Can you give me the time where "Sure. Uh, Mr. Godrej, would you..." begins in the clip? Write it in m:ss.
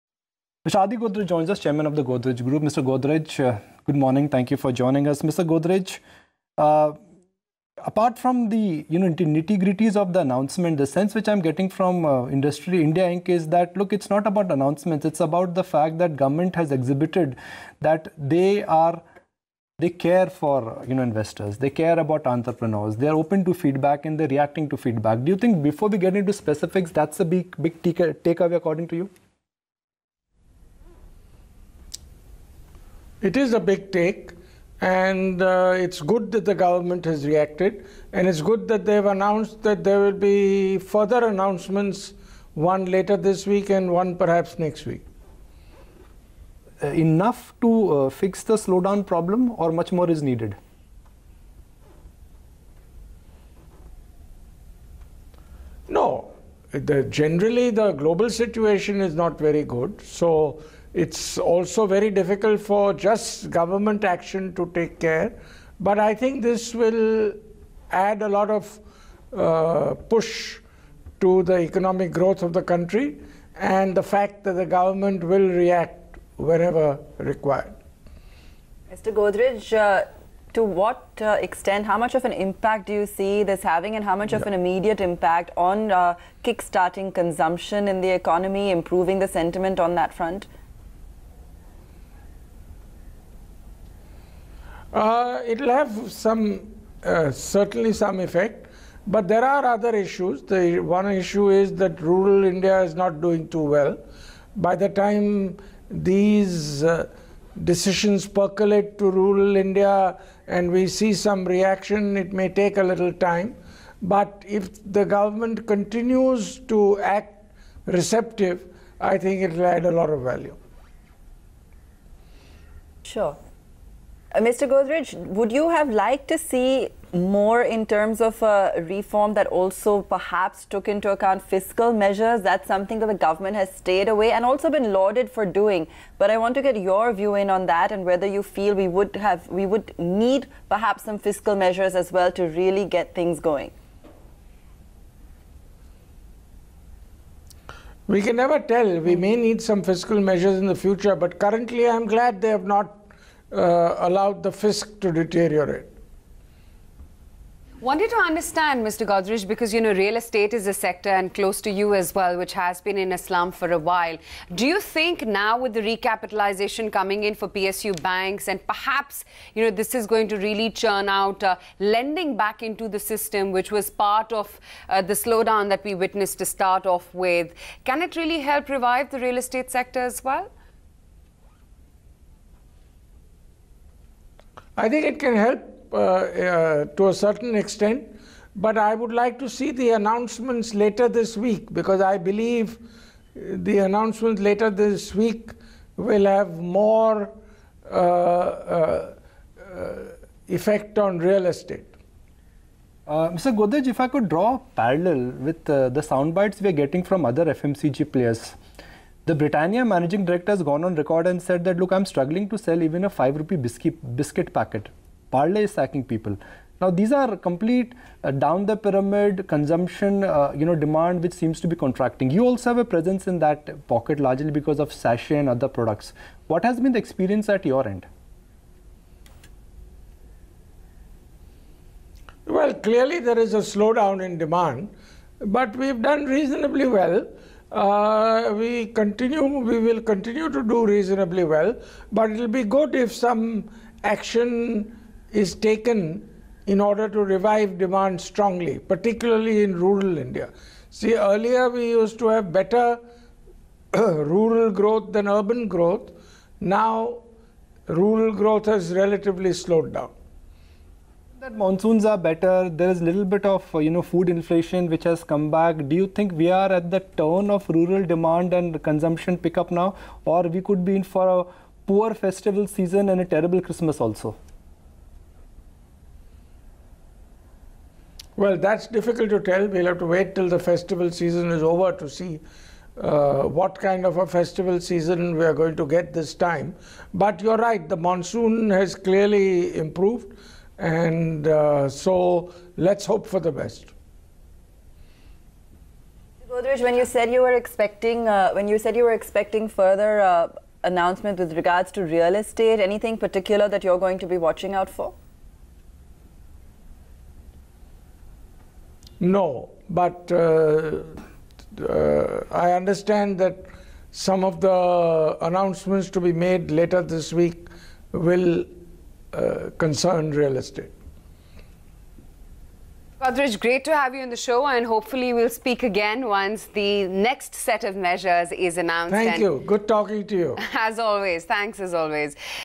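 2:03.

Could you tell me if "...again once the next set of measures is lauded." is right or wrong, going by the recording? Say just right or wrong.
wrong.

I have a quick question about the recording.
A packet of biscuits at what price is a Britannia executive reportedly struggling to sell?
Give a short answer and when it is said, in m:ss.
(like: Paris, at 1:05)
5 rupees, at 3:33.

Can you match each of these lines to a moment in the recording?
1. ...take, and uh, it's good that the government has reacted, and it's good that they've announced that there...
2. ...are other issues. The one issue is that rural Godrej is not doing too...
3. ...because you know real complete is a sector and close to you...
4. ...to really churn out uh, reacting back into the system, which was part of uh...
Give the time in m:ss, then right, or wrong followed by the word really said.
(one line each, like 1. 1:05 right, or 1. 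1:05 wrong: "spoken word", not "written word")
1. 0:33 right
2. 1:39 wrong: "India", not "Godrej"
3. 2:39 wrong: "estate", not "complete"
4. 2:50 wrong: "lending", not "reacting".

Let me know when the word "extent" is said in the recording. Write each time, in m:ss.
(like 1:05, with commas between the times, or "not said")
1:21, 3:07.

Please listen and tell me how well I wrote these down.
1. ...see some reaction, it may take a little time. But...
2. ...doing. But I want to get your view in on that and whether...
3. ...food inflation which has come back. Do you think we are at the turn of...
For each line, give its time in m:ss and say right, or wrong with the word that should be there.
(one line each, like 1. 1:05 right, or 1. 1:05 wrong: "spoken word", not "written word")
1. 1:50 right
2. 2:15 right
3. 4:24 right.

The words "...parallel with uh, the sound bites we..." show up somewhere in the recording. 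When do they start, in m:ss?
3:24.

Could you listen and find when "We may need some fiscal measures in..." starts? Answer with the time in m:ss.
2:29.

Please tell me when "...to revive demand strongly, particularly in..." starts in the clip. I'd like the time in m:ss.
4:07.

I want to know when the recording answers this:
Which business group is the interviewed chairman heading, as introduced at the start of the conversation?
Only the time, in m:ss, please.
0:02.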